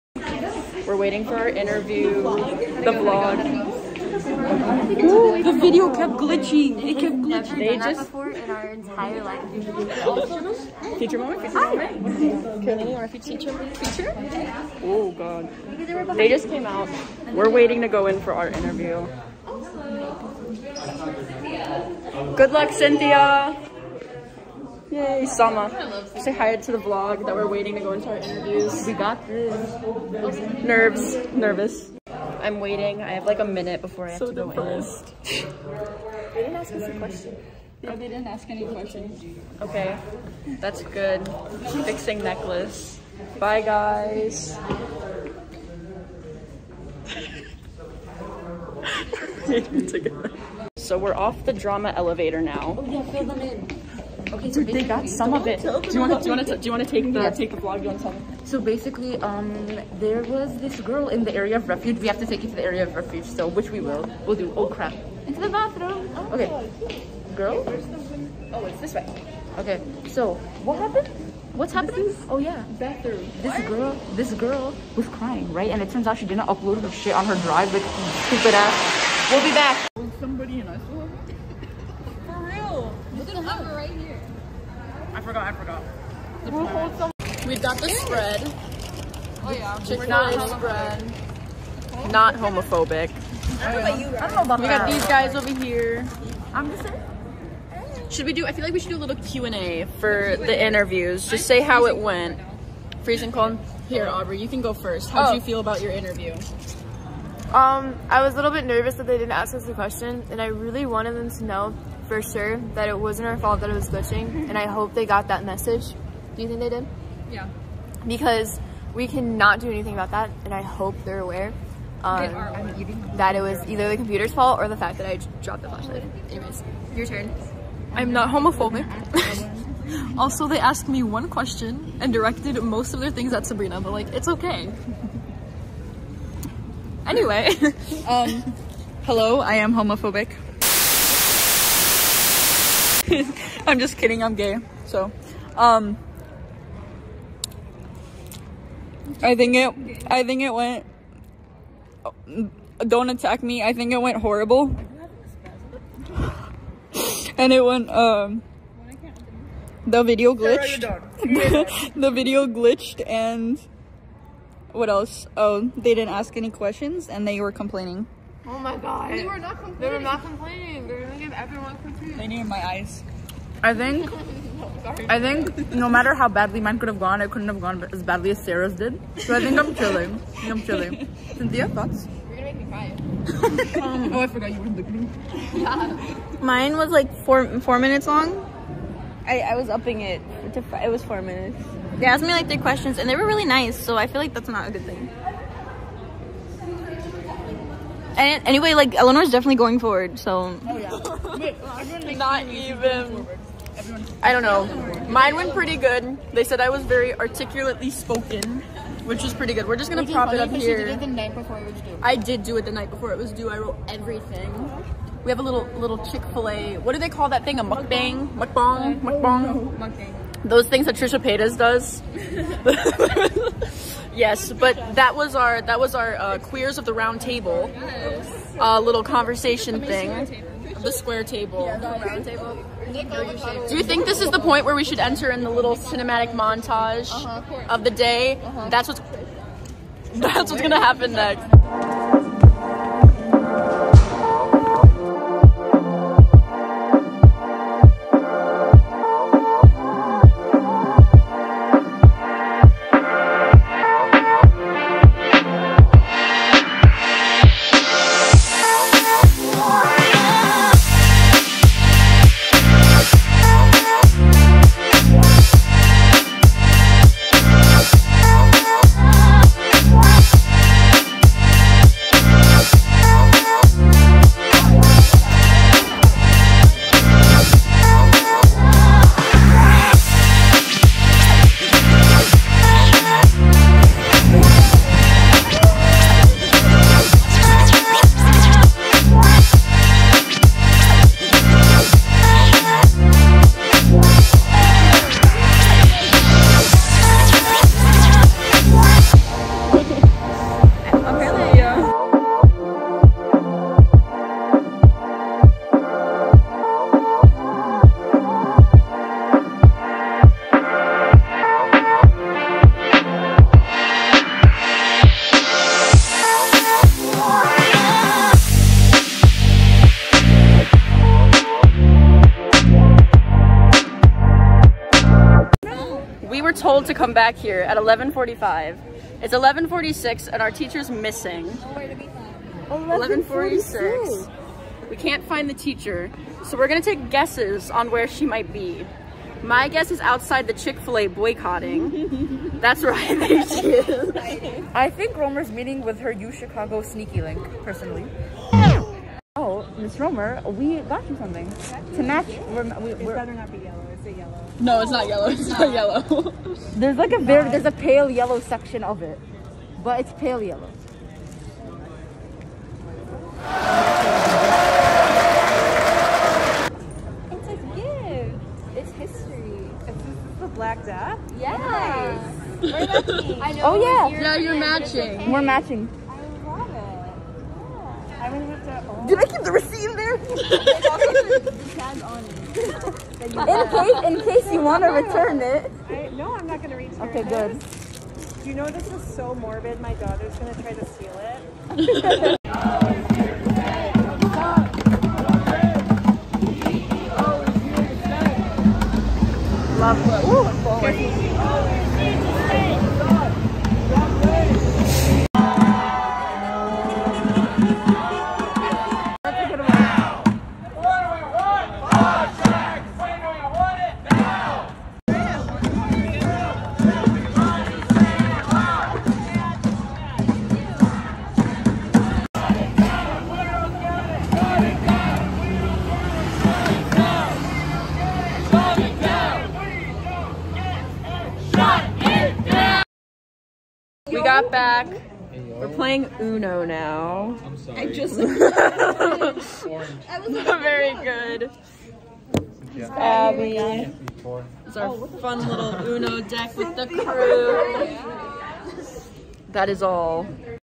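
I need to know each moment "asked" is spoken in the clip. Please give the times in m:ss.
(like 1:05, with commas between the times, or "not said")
2:10, 3:12.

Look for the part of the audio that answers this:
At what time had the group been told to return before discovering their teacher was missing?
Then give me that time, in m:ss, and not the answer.
5:27.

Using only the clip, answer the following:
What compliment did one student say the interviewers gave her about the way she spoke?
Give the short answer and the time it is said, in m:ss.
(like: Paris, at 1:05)
articulately spoken, at 3:27.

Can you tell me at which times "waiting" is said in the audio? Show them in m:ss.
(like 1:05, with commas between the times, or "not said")
0:00, 0:17, 0:27, 0:32.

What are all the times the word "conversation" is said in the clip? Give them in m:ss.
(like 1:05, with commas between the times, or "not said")
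3:49.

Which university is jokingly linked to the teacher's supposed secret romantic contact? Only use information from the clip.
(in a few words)
U Chicago.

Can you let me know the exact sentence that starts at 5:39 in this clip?
My guess is outside the Chick-fil-A boycotting.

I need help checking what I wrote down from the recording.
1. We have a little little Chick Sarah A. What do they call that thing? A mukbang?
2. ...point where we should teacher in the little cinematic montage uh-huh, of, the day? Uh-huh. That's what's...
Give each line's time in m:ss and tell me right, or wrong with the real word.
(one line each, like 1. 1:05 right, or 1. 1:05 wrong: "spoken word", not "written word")
1. 3:35 wrong: "Fil", not "Sarah"
2. 3:54 wrong: "enter", not "teacher".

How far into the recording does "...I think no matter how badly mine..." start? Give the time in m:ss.
2:55.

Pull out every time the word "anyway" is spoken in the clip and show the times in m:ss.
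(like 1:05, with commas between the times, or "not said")
2:06, 2:17, 3:18.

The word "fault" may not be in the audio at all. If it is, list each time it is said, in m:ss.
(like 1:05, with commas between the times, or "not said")
1:53, 2:04.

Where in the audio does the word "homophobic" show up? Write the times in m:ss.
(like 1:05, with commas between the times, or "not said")
1:32, 2:08, 2:19.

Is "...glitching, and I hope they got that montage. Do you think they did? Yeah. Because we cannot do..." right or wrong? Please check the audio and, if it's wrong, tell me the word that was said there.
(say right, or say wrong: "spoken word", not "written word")
wrong: "message", not "montage".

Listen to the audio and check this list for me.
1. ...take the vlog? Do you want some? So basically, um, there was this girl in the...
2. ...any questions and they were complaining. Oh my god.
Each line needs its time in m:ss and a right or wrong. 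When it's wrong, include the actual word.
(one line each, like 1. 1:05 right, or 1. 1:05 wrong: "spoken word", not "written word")
1. 0:57 right
2. 2:46 right.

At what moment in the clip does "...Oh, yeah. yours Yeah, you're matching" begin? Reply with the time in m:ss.
6:13.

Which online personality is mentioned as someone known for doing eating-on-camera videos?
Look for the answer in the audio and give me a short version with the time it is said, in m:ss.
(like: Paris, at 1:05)
Trisha Paytas, at 3:40.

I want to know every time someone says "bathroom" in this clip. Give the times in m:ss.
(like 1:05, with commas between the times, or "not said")
1:05, 1:12.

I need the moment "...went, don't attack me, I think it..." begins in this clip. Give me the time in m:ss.
2:30.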